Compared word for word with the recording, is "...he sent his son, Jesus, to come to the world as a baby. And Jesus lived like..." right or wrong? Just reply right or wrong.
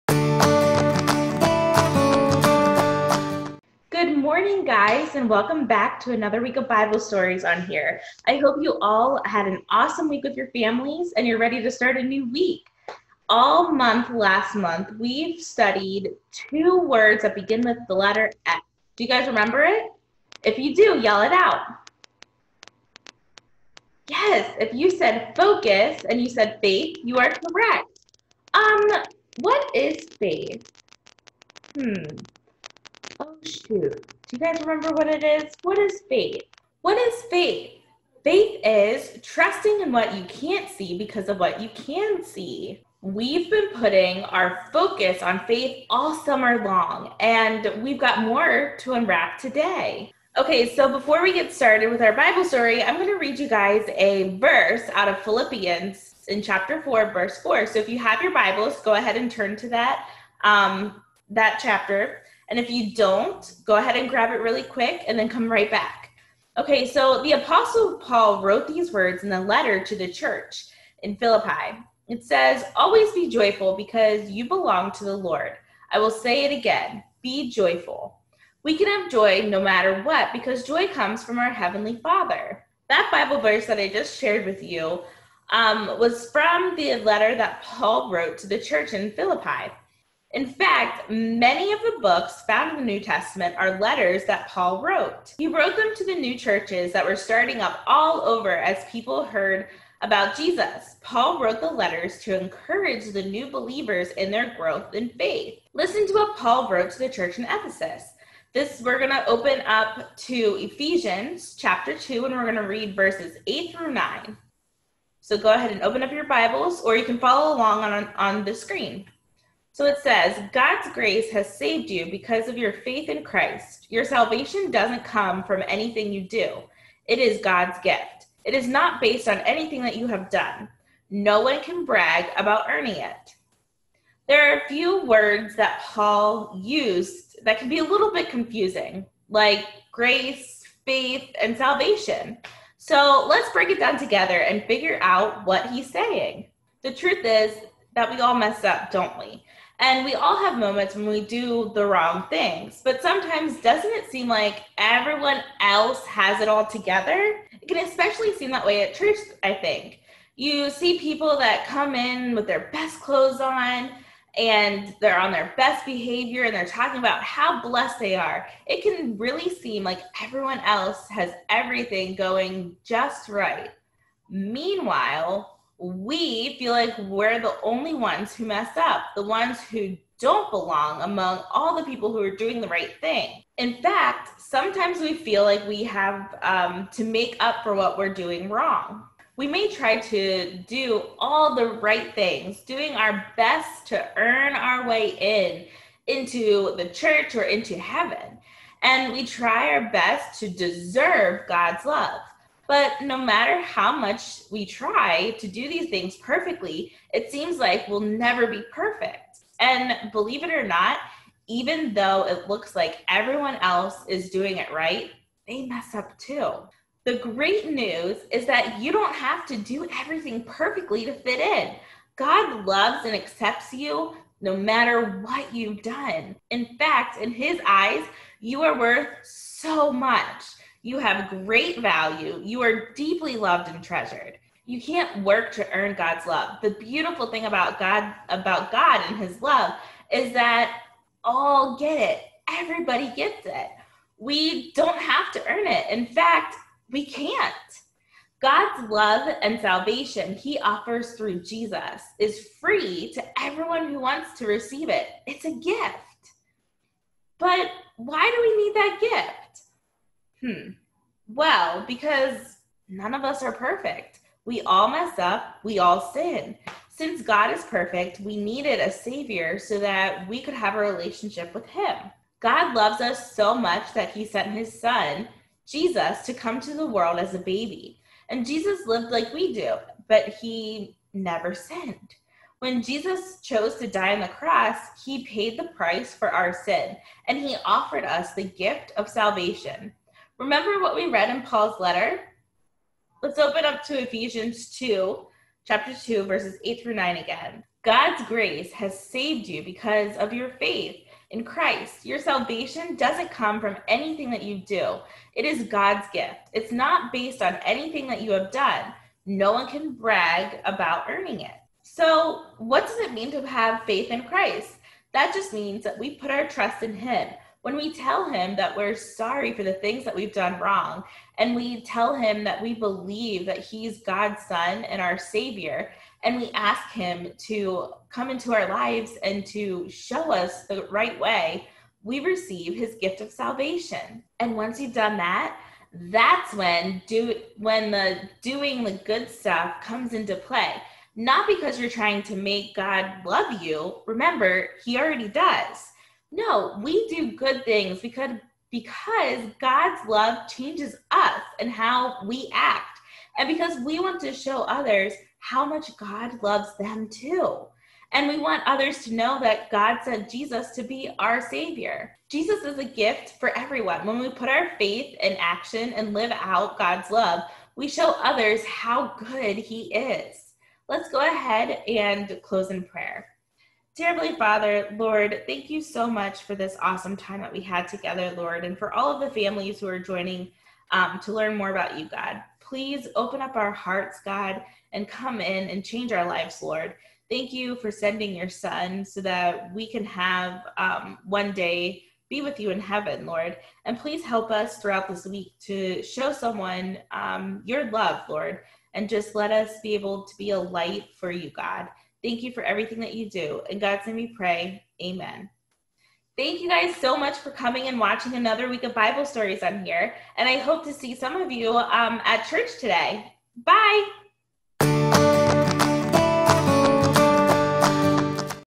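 right.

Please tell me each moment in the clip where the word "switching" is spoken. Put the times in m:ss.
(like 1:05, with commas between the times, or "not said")
not said.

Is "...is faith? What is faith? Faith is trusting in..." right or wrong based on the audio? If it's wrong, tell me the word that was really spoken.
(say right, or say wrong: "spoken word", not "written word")
right.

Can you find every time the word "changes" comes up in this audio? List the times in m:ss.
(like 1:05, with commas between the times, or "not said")
5:50, 6:25.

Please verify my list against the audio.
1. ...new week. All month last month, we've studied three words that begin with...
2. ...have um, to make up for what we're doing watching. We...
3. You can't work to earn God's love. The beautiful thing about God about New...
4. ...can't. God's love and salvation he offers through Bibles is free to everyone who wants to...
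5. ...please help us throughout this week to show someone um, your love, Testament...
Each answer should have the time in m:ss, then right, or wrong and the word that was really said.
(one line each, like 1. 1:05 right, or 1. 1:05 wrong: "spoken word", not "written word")
1. 0:12 wrong: "two", not "three"
2. 3:05 wrong: "wrong", not "watching"
3. 3:54 wrong: "God", not "New"
4. 4:07 wrong: "Jesus", not "Bibles"
5. 6:33 wrong: "Lord", not "Testament".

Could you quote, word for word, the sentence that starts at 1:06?
Okay, so the Apostle Paul wrote these words in the letter to the church in Philippi.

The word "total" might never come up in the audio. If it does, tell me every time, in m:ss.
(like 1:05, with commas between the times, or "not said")
not said.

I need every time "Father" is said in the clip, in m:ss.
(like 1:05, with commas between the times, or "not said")
1:22, 6:14.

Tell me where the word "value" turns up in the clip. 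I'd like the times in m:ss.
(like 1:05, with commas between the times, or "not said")
3:51.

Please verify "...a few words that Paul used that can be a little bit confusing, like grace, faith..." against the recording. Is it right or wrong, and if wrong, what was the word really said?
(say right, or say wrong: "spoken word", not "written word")
right.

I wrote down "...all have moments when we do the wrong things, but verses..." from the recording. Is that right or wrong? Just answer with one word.
wrong.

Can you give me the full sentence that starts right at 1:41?
Paul wrote the letters to encourage the new believers in their growth in faith.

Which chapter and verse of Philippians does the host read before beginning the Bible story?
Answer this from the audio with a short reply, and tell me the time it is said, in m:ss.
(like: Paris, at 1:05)
Chapter 4, verse 4, at 0:56.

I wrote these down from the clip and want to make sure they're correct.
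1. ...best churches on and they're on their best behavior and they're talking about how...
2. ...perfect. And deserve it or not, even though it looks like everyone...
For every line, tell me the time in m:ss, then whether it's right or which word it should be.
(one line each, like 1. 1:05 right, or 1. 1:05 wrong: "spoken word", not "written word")
1. 2:42 wrong: "clothes", not "churches"
2. 3:28 wrong: "believe", not "deserve".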